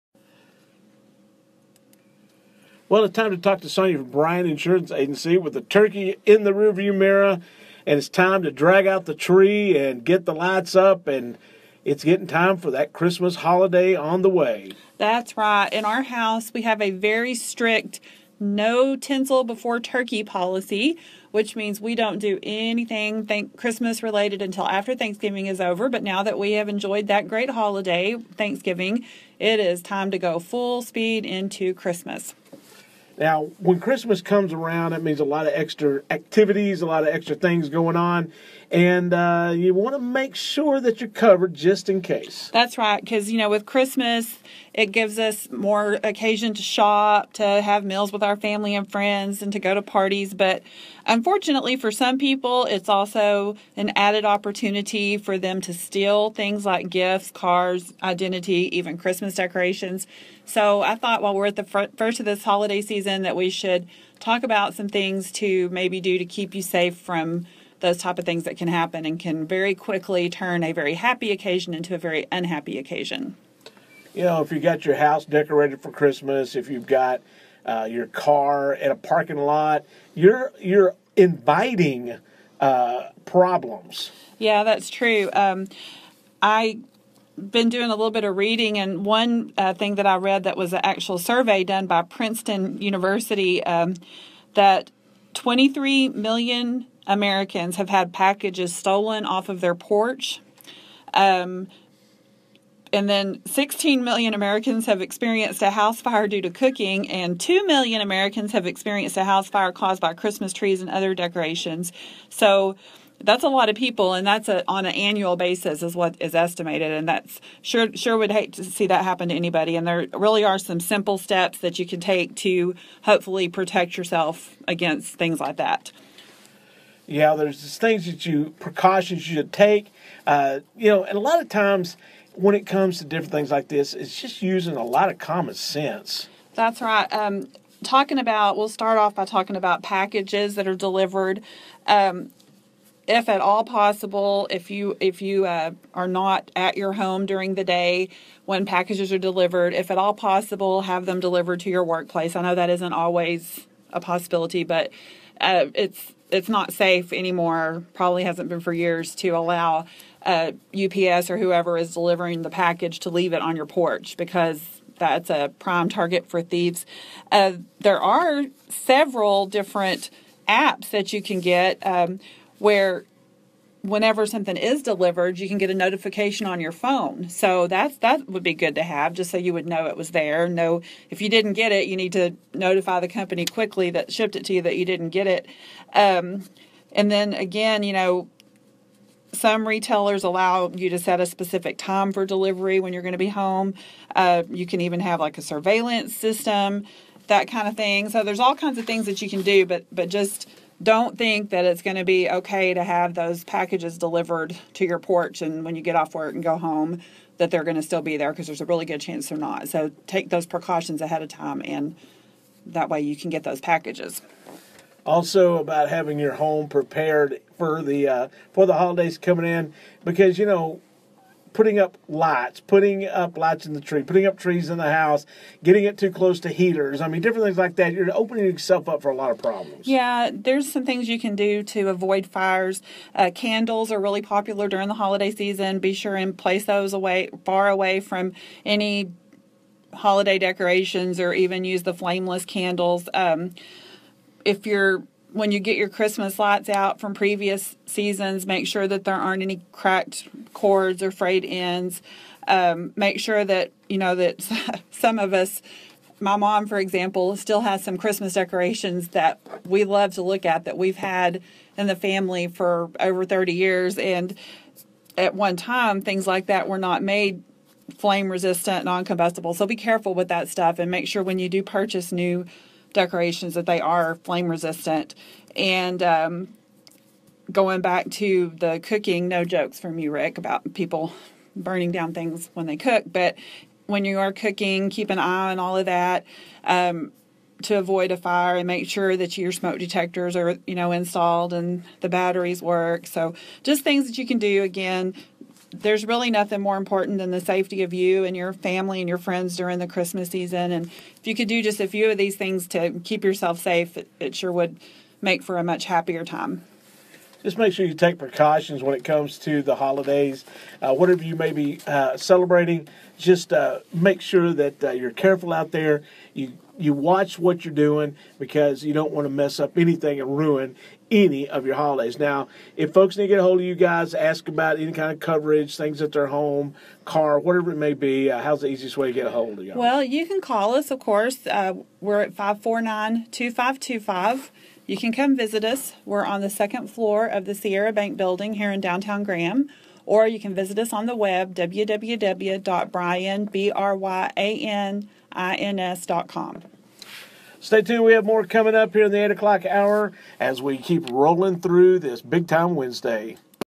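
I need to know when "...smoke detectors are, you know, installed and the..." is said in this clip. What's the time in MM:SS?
04:49.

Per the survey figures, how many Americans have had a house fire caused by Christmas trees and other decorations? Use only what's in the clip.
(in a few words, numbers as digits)
2 million.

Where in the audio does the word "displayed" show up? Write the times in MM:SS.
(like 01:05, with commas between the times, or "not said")
not said.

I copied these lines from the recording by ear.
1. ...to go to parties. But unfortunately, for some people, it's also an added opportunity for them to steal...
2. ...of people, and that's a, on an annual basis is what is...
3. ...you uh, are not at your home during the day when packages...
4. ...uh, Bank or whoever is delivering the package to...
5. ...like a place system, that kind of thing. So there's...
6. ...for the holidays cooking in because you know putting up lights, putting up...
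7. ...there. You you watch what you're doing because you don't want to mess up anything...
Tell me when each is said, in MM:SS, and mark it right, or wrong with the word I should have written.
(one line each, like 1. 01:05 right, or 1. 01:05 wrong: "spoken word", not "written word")
1. 00:49 right
2. 01:53 right
3. 02:25 right
4. 02:40 wrong: "UPS", not "Bank"
5. 03:15 wrong: "surveillance", not "place"
6. 03:38 wrong: "coming", not "cooking"
7. 05:15 right.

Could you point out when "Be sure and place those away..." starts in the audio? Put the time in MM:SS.
03:55.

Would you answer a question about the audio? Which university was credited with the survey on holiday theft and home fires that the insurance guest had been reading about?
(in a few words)
Princeton University.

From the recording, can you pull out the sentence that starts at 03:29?
So take those precautions ahead of time and that way you can get those packages.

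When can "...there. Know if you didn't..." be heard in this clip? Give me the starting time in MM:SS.
03:00.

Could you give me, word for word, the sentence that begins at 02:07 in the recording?
You know, there's just things that you precautions you should take.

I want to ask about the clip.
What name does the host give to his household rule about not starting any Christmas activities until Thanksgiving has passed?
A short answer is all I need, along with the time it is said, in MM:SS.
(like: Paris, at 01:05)
No tinsel before turkey, at 00:18.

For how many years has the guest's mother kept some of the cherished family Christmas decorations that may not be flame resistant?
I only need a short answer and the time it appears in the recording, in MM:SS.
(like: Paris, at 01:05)
Over 30 years, at 04:22.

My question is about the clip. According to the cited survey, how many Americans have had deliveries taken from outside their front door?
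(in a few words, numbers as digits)
23 million.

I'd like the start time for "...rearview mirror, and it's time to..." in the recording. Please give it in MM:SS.
00:06.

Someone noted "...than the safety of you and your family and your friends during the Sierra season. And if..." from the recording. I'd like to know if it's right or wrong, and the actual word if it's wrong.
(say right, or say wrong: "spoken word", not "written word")
wrong: "Christmas", not "Sierra".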